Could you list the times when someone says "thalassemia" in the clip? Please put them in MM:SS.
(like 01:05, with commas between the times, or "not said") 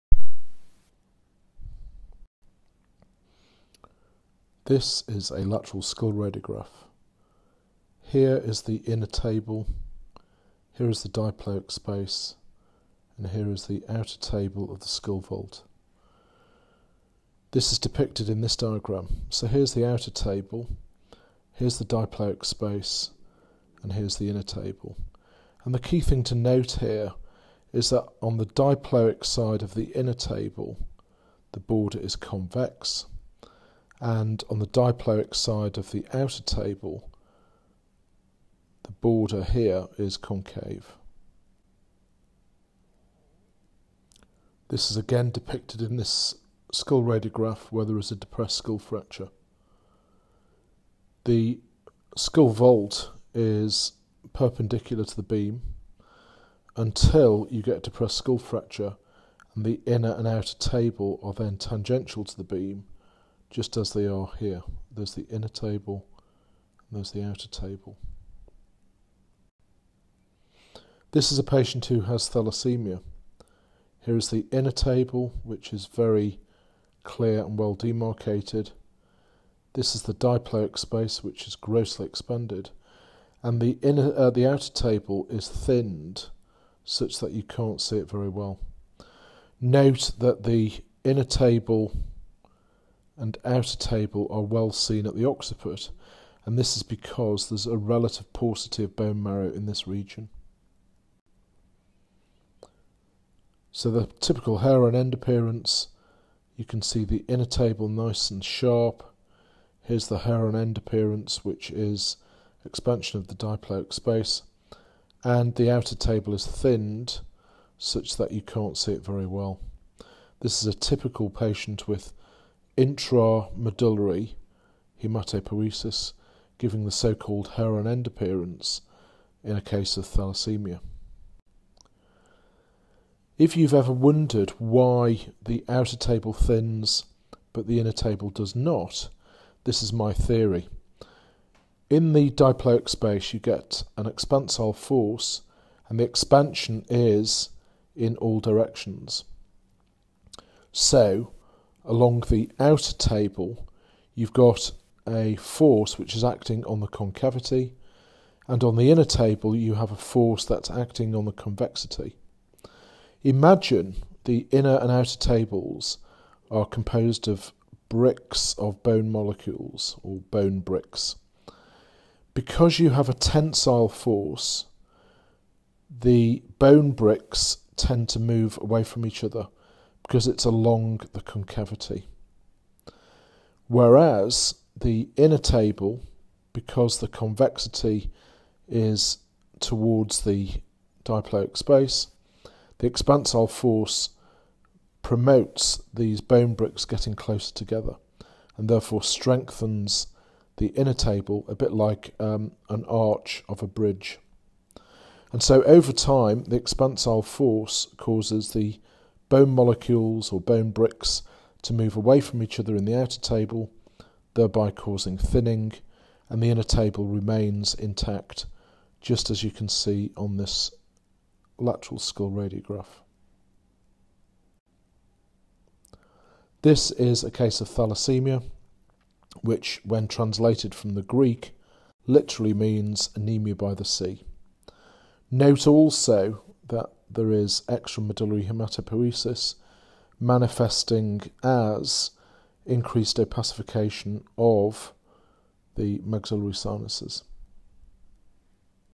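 01:12, 02:10, 03:47.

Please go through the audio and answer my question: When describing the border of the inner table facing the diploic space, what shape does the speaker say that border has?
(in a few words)
Convex.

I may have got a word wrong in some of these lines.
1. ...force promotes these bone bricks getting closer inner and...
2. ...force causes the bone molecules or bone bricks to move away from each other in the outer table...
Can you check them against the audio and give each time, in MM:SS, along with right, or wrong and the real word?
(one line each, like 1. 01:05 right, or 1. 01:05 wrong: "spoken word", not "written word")
1. 03:13 wrong: "together", not "inner"
2. 03:27 right.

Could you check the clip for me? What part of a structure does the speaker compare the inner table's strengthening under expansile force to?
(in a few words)
An arch of a bridge.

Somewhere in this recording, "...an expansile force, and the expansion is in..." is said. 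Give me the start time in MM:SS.
02:23.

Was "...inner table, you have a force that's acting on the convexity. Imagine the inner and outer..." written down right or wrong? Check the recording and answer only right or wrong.
right.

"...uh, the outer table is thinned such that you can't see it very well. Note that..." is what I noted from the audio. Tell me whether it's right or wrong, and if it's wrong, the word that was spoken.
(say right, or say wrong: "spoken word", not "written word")
right.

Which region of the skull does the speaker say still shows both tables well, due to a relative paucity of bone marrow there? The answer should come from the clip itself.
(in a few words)
Occiput.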